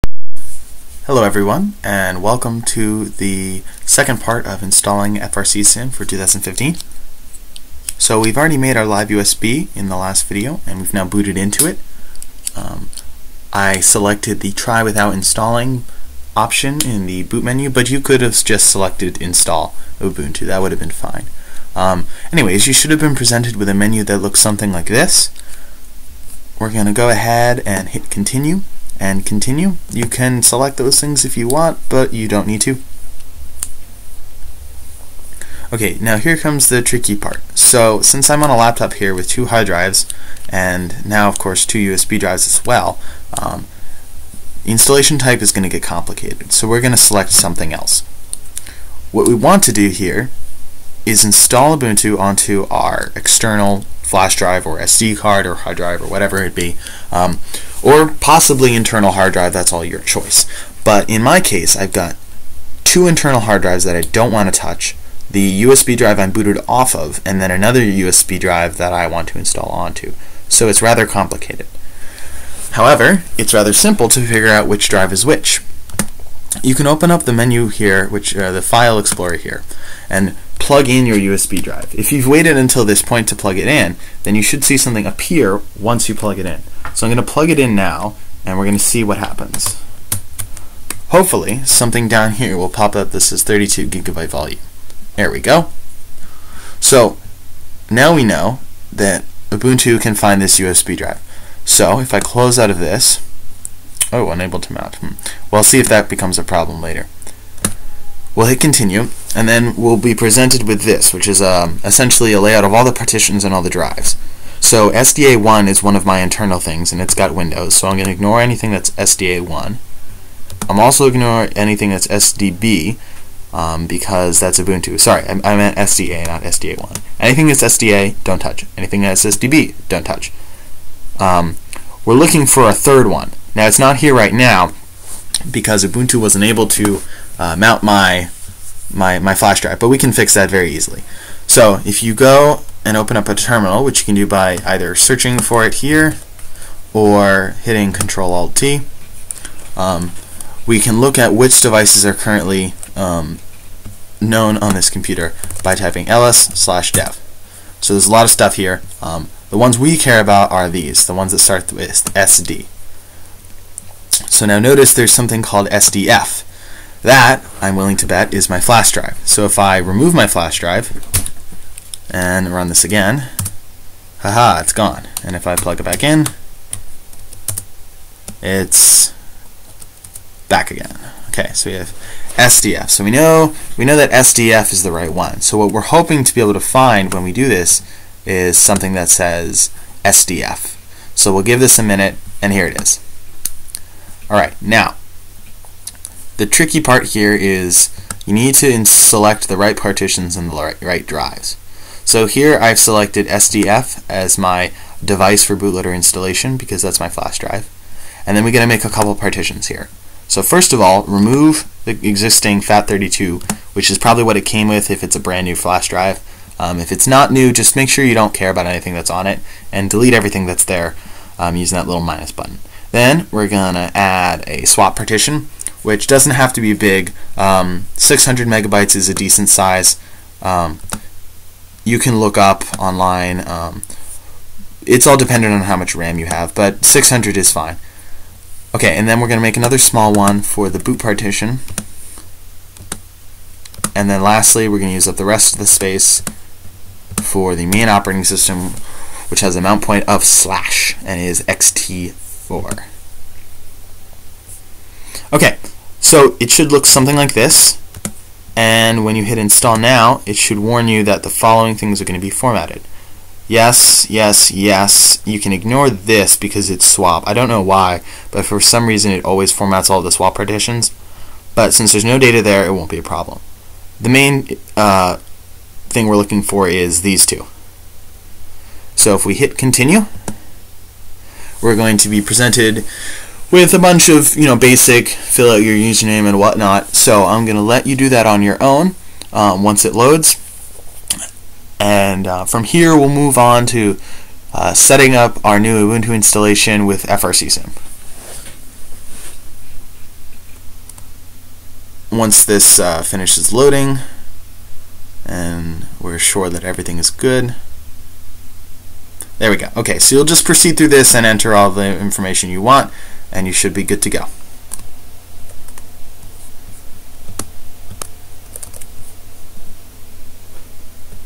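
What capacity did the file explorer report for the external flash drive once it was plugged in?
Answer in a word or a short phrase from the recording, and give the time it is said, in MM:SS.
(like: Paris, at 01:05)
32 gigabytes, at 01:33.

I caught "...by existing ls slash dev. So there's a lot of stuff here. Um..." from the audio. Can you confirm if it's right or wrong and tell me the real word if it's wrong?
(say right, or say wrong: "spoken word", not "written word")
wrong: "typing", not "existing".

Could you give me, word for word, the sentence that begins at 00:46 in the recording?
So we're going to select something else.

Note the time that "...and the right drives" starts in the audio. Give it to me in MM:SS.
03:20.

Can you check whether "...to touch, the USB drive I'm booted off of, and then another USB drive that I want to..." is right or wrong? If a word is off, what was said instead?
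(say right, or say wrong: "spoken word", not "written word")
right.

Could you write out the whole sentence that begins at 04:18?
And when you hit install now, it should warn you that the following things are going to be formatted.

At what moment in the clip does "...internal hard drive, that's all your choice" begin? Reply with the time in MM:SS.
00:58.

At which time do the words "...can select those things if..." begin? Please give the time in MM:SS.
00:30.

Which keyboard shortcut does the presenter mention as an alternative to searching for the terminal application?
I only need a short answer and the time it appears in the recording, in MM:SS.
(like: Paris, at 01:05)
Control Alt T, at 02:27.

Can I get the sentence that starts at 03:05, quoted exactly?
So what we're hoping to be able to find when we do this is something that says SDF.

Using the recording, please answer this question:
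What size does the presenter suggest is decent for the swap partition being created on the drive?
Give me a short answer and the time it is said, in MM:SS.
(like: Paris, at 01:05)
600 megabytes, at 03:47.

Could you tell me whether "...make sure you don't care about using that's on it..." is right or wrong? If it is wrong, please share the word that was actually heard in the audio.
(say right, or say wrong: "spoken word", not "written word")
wrong: "anything", not "using".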